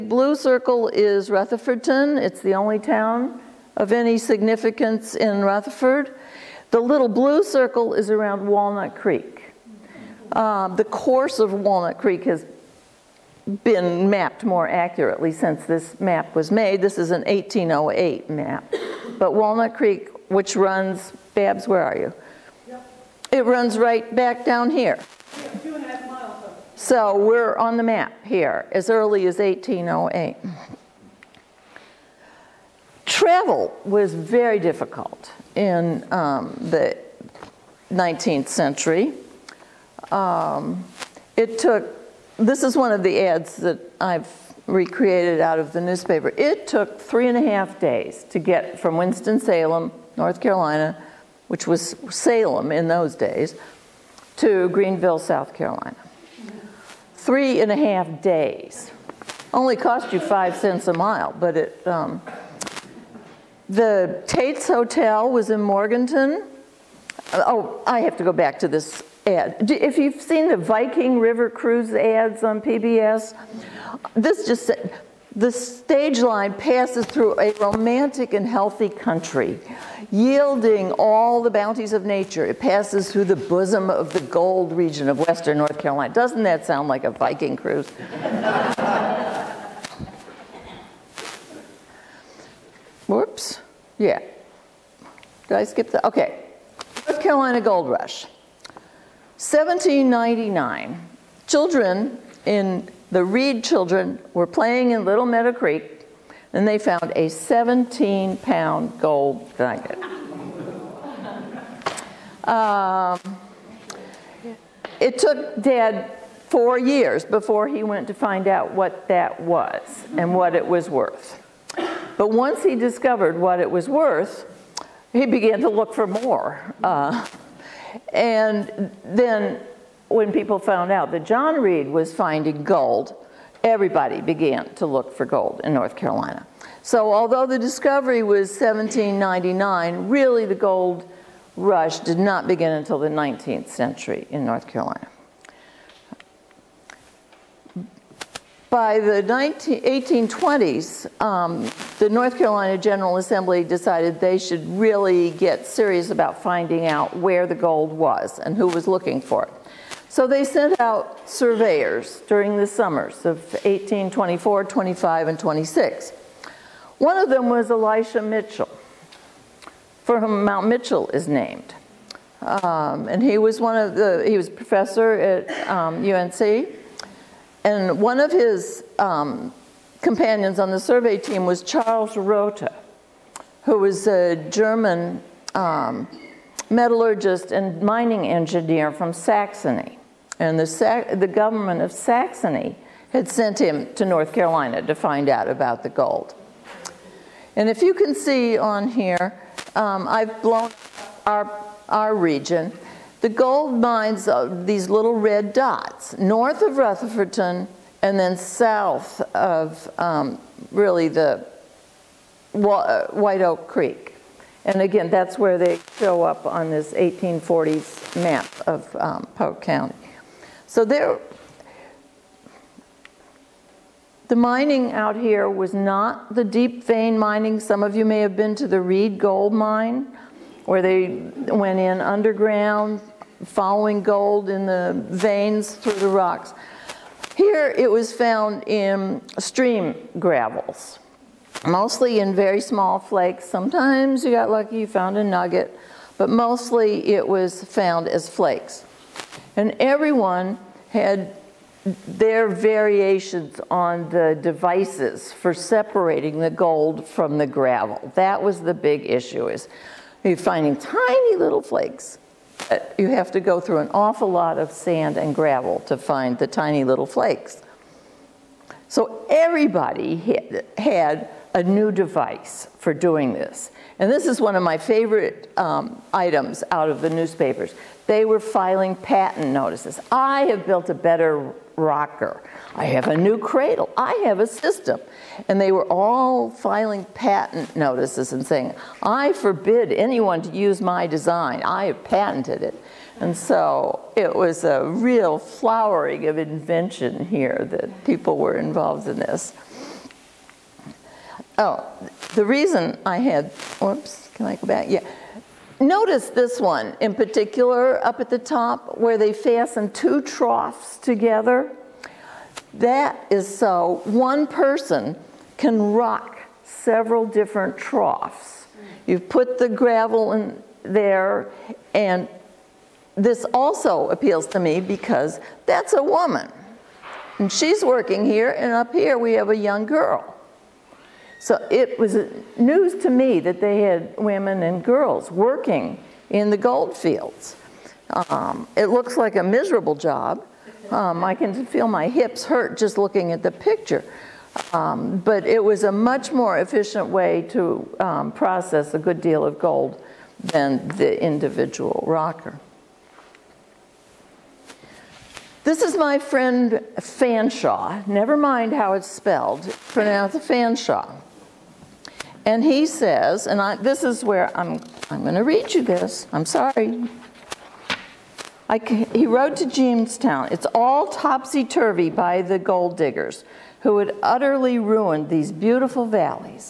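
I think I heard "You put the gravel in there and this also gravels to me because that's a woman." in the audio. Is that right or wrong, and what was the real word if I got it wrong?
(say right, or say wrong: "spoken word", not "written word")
wrong: "appeals", not "gravels".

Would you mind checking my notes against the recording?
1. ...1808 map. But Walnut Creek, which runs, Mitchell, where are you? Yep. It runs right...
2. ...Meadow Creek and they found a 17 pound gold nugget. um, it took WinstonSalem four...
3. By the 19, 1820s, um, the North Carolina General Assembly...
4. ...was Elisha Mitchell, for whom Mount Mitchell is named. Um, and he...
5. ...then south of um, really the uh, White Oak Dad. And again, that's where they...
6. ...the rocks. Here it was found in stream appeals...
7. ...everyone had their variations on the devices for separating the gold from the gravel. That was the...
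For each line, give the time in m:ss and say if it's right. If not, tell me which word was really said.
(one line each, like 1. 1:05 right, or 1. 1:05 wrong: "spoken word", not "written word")
1. 0:17 wrong: "Babs", not "Mitchell"
2. 1:45 wrong: "Dad", not "WinstonSalem"
3. 2:28 right
4. 2:47 right
5. 3:28 wrong: "Creek", not "Dad"
6. 3:55 wrong: "gravels", not "appeals"
7. 4:09 right.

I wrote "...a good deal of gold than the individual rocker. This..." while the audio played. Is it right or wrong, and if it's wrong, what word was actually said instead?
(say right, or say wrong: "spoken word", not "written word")
right.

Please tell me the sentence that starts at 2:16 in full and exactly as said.
So although the discovery was 1799, really the gold rush did not begin until the 19th century in North Carolina.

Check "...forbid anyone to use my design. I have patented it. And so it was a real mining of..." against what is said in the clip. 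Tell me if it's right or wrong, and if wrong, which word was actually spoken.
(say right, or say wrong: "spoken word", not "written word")
wrong: "flowering", not "mining".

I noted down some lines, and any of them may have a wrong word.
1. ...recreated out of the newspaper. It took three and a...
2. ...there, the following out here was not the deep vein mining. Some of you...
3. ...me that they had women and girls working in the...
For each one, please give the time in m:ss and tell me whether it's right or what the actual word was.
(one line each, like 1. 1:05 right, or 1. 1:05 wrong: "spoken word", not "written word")
1. 0:44 right
2. 3:40 wrong: "mining", not "following"
3. 5:33 right.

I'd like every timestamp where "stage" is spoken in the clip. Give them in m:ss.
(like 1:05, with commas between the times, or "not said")
1:15.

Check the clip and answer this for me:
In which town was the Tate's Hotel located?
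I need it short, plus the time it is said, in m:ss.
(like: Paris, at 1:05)
Morganton, at 1:05.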